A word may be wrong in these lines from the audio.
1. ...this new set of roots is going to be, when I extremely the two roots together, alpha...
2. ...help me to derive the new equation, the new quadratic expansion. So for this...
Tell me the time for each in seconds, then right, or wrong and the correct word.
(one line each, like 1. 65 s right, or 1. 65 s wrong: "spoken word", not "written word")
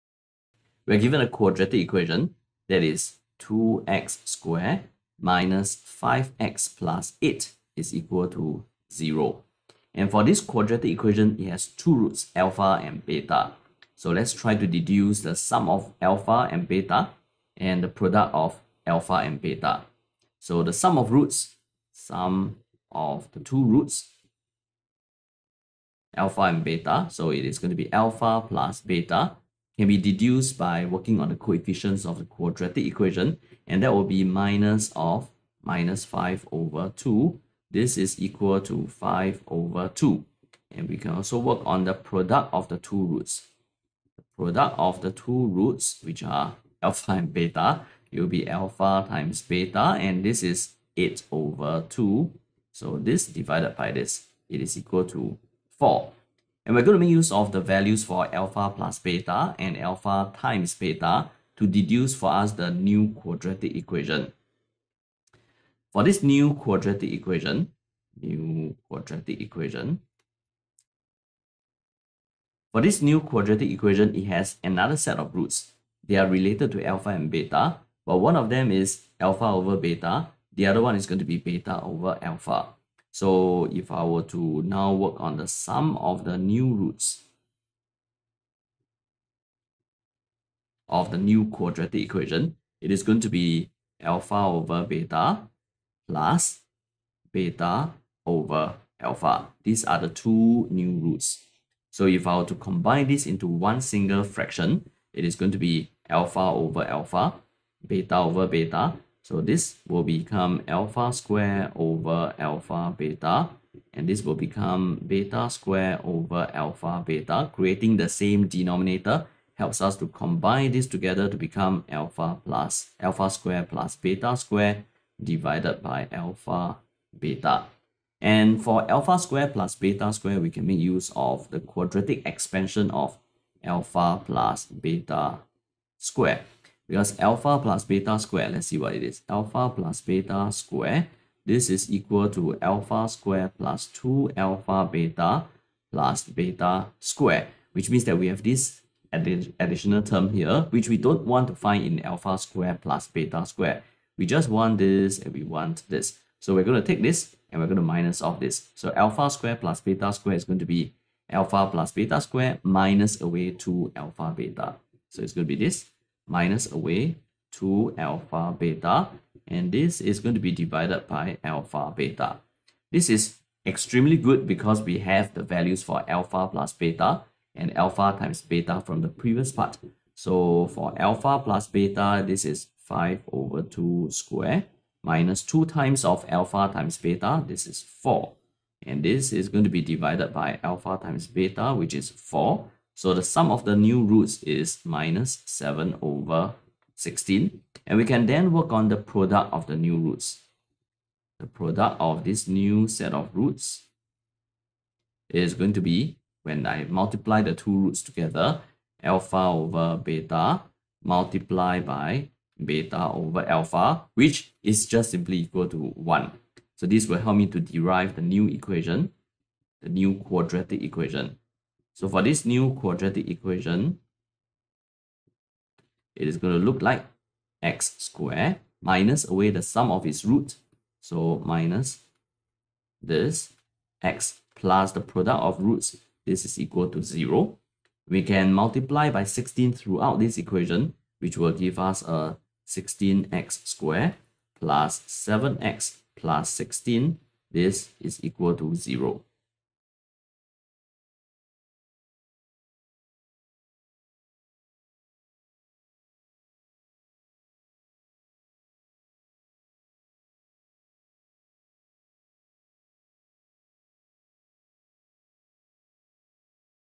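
1. 202 s wrong: "multiply", not "extremely"
2. 217 s wrong: "equation", not "expansion".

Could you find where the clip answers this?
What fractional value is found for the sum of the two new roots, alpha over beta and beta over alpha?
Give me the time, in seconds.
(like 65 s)
194 s.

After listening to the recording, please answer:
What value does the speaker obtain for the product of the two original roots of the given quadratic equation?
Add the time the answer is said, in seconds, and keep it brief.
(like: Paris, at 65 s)
4, at 54 s.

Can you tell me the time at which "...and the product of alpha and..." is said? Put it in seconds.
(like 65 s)
17 s.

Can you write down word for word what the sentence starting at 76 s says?
They are related to alpha and beta, but one of them is alpha over beta.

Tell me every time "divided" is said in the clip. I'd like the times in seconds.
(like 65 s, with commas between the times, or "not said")
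53 s, 125 s, 170 s, 189 s.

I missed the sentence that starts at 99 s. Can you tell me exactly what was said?
These are the two new roots.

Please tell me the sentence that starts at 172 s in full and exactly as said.
This is extremely good because we have the values for alpha plus beta and alpha times beta from the previous part.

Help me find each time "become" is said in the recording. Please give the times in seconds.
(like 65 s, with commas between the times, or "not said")
110 s, 114 s, 121 s.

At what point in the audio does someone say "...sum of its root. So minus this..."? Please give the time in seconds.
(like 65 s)
229 s.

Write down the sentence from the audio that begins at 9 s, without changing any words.
And for this quadratic equation, it has two roots, alpha and beta.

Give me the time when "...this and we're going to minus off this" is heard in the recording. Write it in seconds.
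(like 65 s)
157 s.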